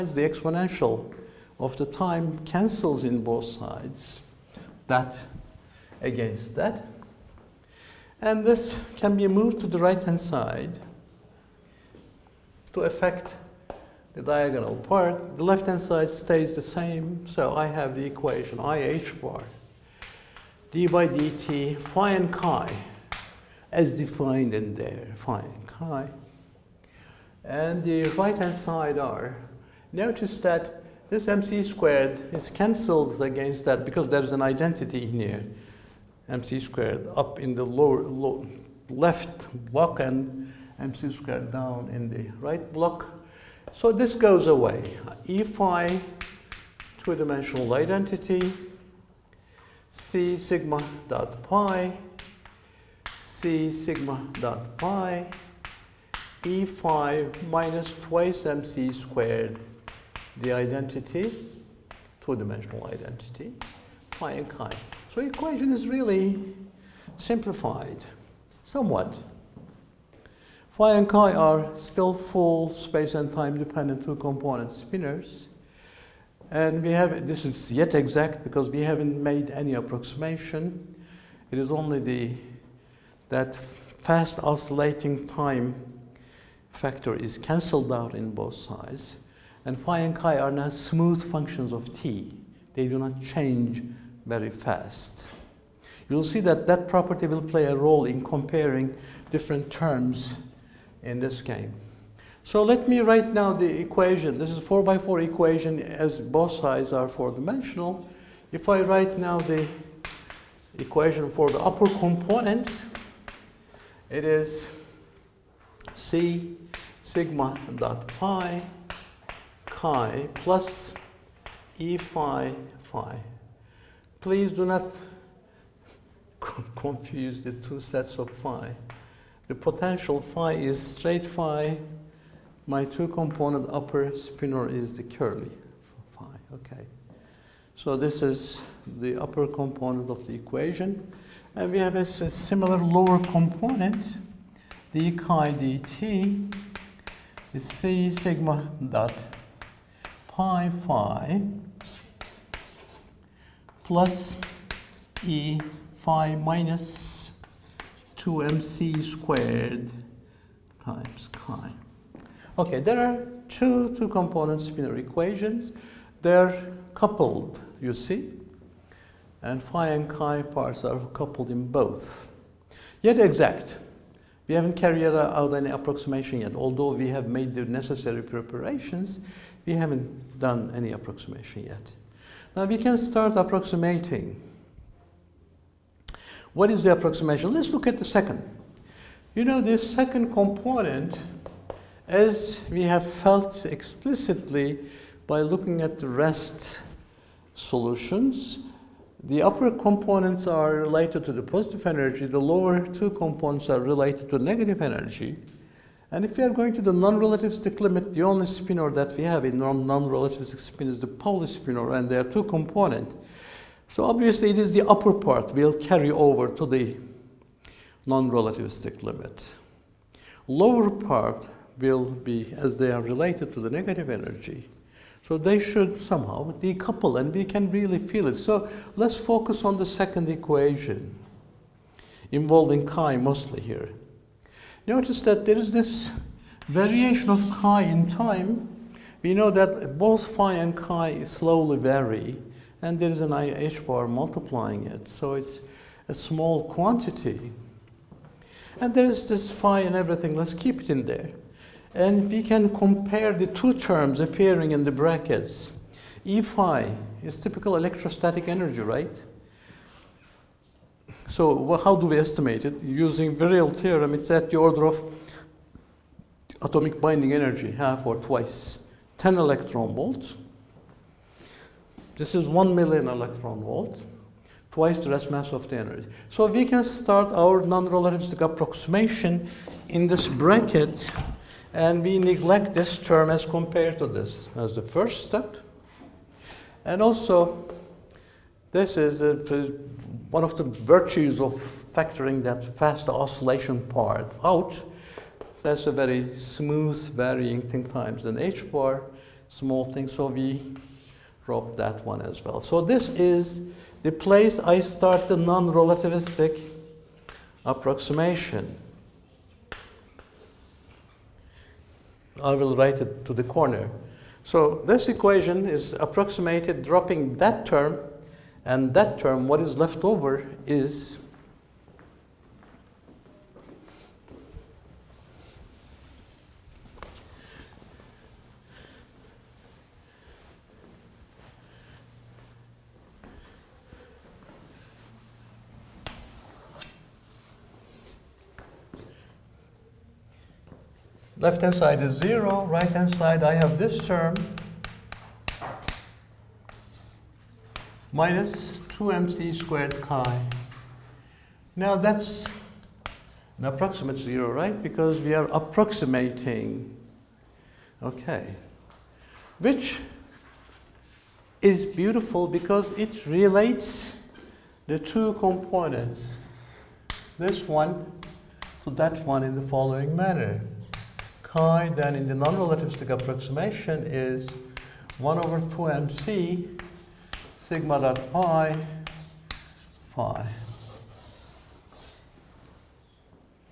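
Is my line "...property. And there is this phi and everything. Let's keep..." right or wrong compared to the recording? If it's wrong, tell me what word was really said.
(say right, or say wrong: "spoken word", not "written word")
wrong: "quantity", not "property".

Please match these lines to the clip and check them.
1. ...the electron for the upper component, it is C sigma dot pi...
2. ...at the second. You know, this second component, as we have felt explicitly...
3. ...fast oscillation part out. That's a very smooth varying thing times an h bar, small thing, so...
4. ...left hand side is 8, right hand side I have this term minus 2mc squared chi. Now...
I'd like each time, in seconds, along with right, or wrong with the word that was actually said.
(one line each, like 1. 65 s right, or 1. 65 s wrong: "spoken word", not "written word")
1. 109 s wrong: "equation", not "electron"
2. 187 s right
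3. 292 s right
4. 341 s wrong: "0", not "8".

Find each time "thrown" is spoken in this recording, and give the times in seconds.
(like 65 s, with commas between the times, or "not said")
not said.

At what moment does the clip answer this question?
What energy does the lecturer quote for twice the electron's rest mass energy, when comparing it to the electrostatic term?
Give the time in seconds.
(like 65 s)
272 s.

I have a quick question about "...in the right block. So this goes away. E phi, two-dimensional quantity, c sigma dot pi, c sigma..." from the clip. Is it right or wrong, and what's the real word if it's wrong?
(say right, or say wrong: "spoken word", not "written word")
wrong: "identity", not "quantity".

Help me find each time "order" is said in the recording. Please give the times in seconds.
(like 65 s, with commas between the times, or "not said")
264 s.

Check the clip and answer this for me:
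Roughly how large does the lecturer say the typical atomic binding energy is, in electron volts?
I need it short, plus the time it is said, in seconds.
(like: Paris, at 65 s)
10 electron volts, at 269 s.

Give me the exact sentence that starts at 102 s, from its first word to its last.
So let me write now the equation.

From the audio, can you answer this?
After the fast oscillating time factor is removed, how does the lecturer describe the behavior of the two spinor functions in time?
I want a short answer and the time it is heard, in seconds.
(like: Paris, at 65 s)
smooth functions of t, at 90 s.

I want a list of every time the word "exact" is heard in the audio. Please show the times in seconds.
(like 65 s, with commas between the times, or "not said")
77 s, 173 s.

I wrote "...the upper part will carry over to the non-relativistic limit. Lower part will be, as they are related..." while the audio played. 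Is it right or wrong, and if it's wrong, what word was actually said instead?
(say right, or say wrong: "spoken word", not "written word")
right.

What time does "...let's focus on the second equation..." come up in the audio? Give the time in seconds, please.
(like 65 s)
228 s.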